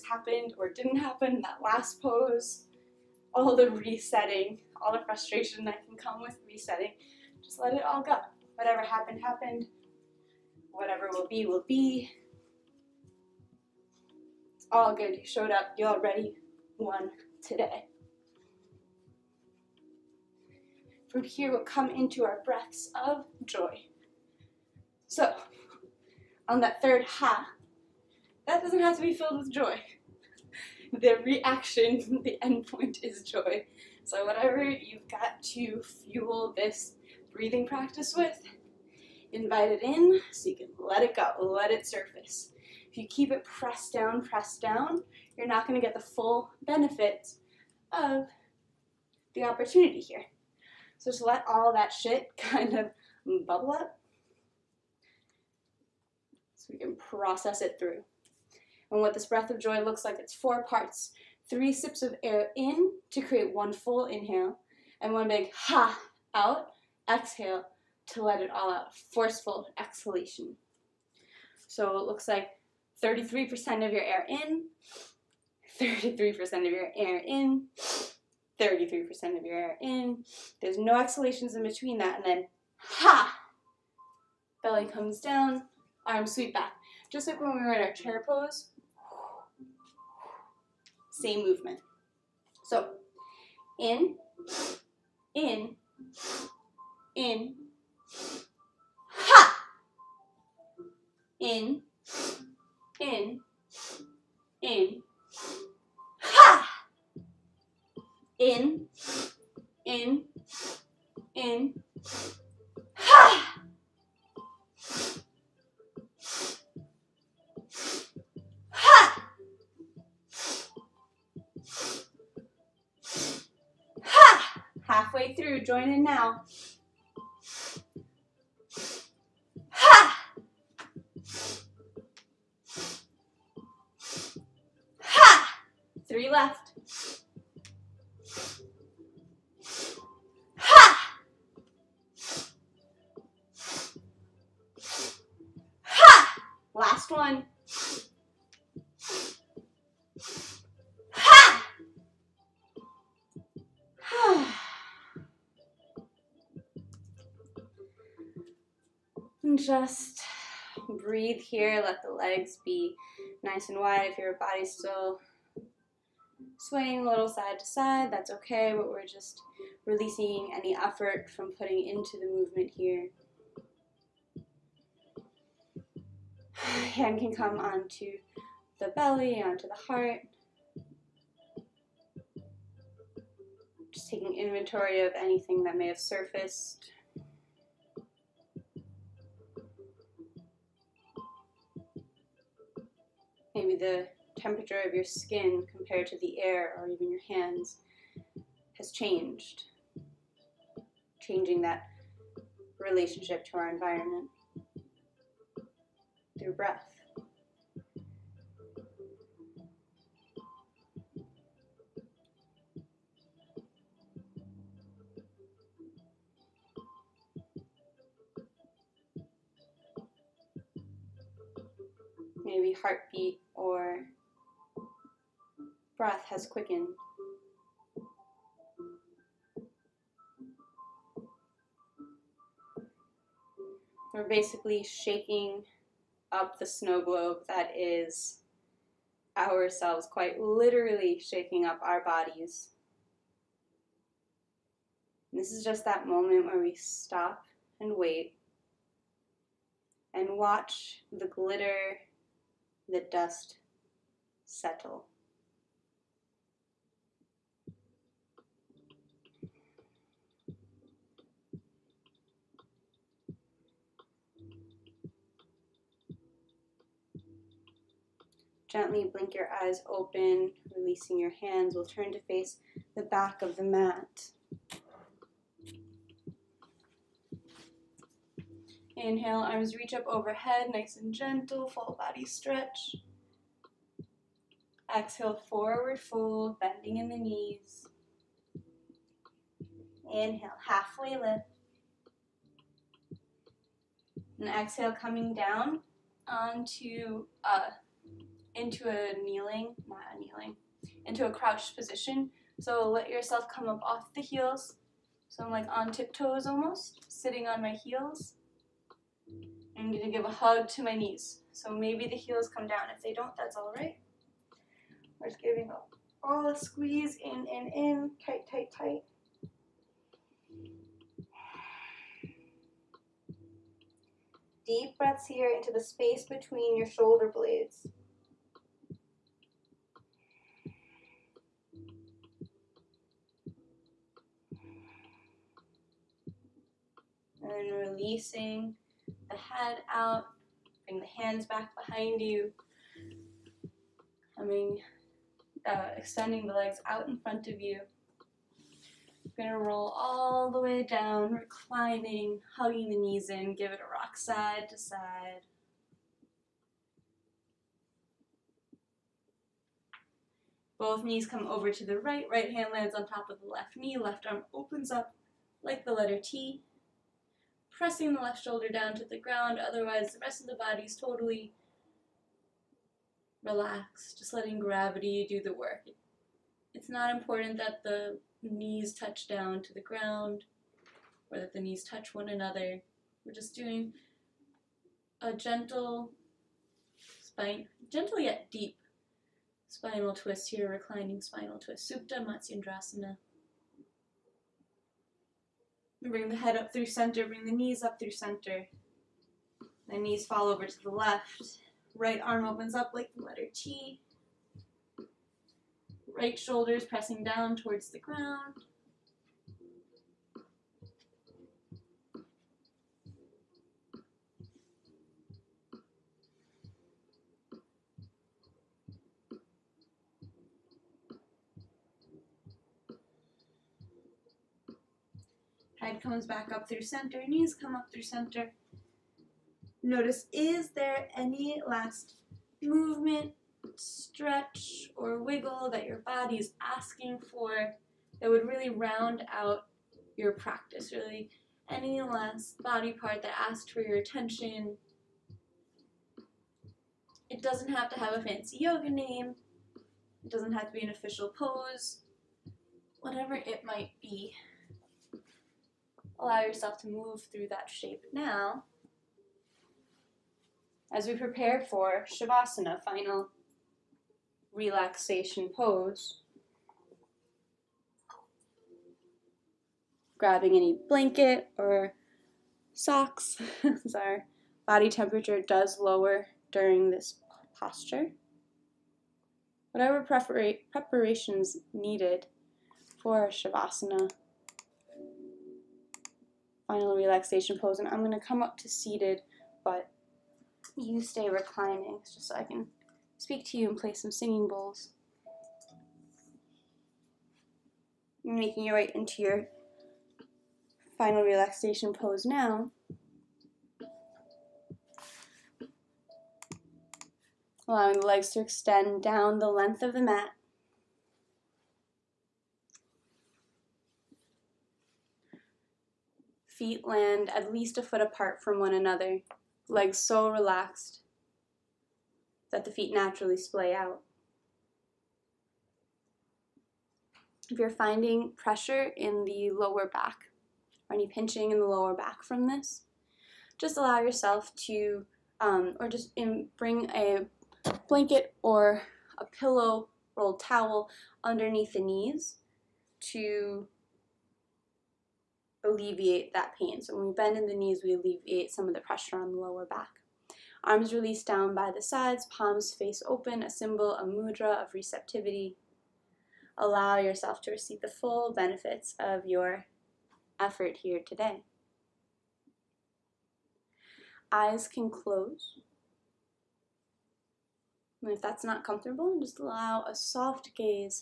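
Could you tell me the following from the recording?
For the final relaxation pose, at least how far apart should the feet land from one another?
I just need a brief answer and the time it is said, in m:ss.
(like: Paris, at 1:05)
a foot, at 8:37.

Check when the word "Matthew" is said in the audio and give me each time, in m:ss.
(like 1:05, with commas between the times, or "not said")
not said.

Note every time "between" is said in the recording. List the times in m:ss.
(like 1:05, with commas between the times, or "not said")
1:21, 5:26.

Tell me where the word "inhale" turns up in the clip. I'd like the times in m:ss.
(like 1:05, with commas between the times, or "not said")
1:04, 4:38, 4:50.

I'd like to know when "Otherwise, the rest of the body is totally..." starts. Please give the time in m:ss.
6:09.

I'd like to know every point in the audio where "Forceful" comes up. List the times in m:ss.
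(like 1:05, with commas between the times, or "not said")
1:09.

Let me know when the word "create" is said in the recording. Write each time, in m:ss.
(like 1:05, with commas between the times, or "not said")
1:03.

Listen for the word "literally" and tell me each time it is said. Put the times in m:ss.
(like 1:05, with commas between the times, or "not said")
4:00.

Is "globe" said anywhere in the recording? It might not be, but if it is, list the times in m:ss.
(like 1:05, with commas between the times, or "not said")
3:57.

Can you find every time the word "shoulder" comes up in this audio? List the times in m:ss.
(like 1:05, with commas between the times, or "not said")
5:26, 6:08, 6:46.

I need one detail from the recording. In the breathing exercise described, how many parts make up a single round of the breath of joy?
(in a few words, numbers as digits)
4.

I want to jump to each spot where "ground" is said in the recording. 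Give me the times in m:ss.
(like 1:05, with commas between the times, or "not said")
6:09, 6:19, 6:47.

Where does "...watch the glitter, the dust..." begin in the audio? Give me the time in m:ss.
4:10.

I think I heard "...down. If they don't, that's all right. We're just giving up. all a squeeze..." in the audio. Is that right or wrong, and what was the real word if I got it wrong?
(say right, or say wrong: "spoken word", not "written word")
right.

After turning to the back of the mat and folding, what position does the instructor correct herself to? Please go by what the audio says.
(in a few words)
crouched position.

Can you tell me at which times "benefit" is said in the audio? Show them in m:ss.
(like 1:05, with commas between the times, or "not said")
0:46, 9:18.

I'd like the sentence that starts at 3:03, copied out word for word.
Just taking inventory of anything that may have surfaced.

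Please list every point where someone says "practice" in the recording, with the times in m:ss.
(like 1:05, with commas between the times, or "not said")
0:37, 7:20.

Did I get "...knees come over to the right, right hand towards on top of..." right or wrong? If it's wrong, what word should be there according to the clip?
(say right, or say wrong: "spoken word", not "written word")
wrong: "lands", not "towards".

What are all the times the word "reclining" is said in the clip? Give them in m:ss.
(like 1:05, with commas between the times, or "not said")
5:51, 6:30, 8:11.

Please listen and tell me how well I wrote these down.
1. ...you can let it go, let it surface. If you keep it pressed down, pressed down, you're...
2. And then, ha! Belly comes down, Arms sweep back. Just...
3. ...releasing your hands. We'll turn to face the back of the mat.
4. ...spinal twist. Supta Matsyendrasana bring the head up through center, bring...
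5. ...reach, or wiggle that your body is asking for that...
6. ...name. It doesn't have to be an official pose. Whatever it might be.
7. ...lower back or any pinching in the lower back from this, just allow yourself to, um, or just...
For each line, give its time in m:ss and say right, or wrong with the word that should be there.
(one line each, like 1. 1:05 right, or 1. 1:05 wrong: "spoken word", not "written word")
1. 0:40 right
2. 1:22 right
3. 4:30 right
4. 6:31 right
5. 7:13 wrong: "stretch", not "reach"
6. 7:28 right
7. 8:49 right.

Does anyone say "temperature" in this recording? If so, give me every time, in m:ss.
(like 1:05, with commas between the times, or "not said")
3:14, 7:54.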